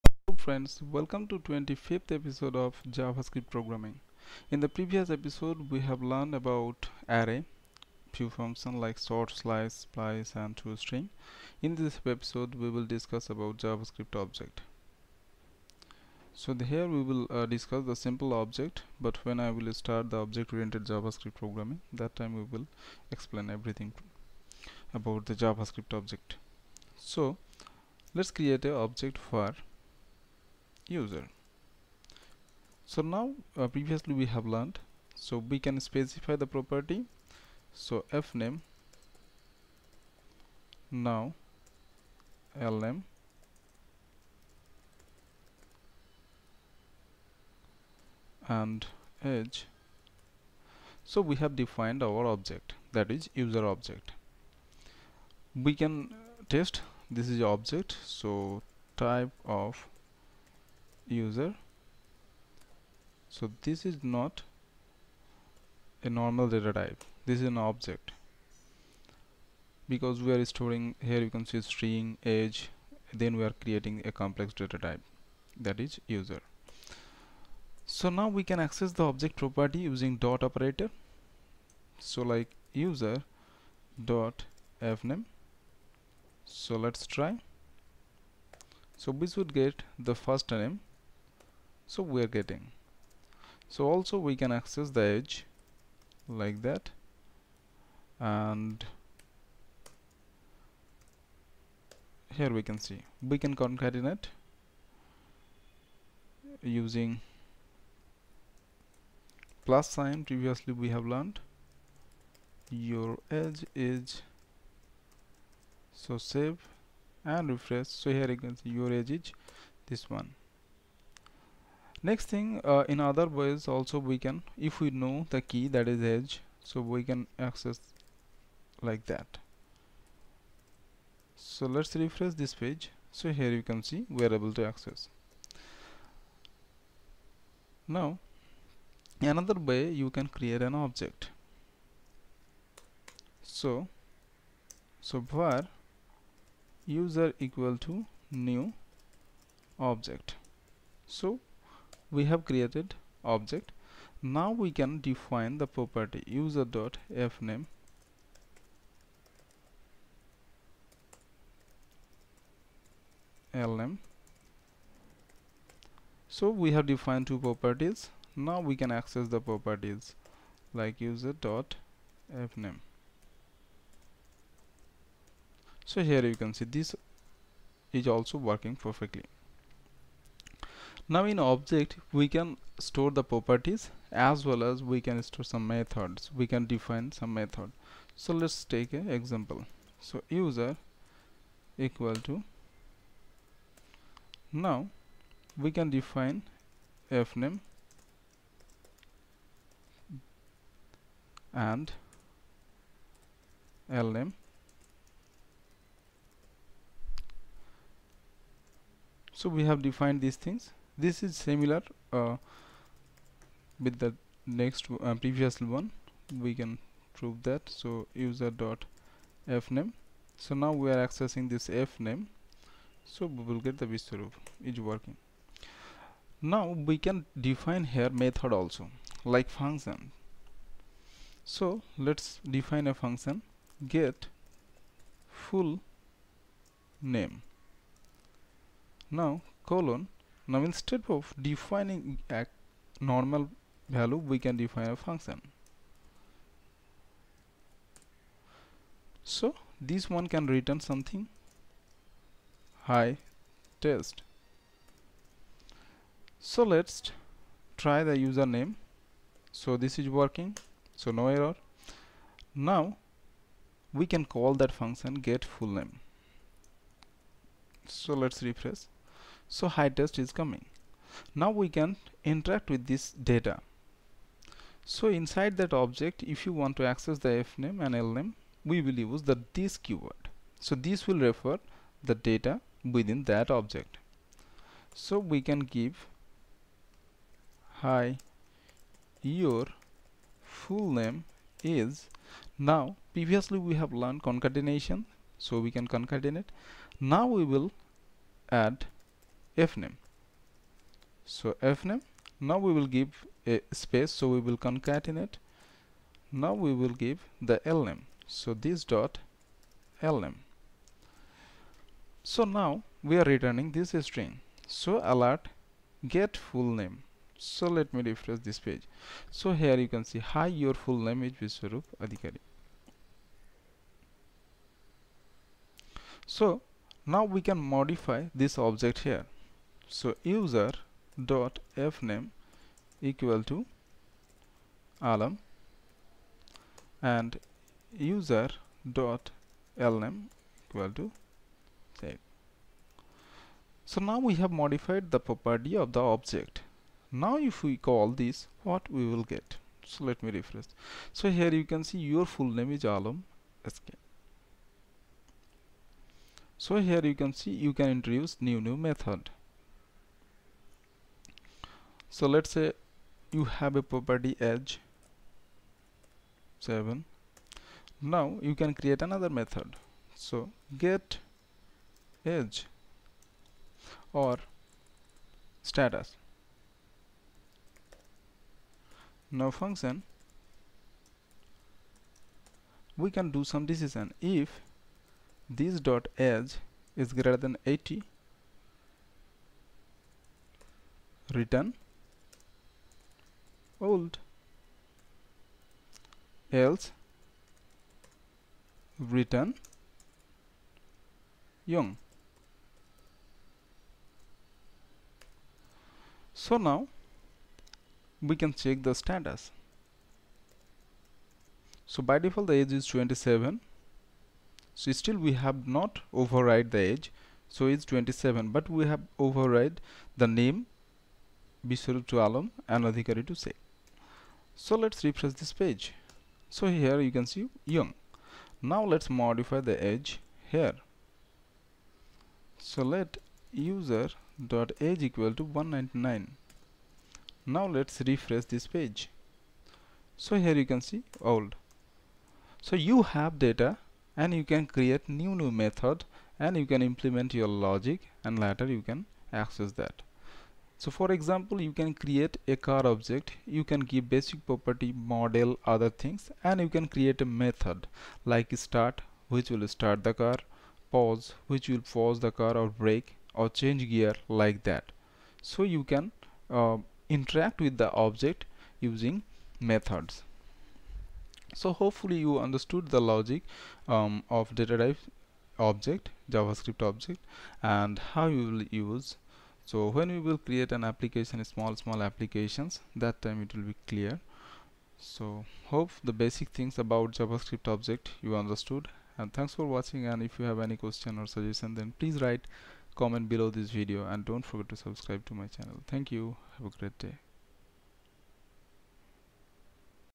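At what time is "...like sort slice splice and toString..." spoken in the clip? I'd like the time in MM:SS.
00:08.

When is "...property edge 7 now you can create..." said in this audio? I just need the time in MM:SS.
06:03.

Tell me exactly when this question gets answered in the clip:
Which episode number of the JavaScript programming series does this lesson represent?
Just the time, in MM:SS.
00:01.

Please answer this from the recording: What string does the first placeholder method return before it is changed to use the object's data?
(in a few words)
hi test.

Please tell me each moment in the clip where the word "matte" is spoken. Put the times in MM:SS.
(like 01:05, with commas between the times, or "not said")
not said.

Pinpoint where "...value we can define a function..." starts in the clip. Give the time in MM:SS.
04:03.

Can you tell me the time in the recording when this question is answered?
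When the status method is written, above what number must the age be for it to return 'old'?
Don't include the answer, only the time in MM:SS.
06:27.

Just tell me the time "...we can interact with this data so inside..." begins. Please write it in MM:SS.
04:31.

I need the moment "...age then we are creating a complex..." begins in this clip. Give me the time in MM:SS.
01:12.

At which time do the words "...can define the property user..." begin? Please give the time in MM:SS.
02:34.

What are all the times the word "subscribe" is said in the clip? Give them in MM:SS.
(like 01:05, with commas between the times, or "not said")
08:14.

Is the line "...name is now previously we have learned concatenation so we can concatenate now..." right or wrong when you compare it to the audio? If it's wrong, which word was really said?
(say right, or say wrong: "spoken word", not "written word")
right.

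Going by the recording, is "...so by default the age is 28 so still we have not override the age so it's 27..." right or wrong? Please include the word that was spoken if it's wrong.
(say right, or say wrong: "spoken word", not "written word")
wrong: "27", not "28".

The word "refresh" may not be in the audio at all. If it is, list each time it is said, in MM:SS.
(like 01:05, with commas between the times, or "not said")
01:57, 02:11, 04:28, 05:18, 05:50, 07:05, 07:18.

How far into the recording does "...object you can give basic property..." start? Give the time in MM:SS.
07:32.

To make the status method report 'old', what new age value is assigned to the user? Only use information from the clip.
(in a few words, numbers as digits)
199.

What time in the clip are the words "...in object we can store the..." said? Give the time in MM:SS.
03:01.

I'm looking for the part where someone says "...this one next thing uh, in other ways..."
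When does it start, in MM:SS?
01:59.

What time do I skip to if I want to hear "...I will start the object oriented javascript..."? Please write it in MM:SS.
00:19.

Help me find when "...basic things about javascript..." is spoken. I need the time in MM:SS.
08:06.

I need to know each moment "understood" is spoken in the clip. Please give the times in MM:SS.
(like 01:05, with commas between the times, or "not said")
07:52, 08:08.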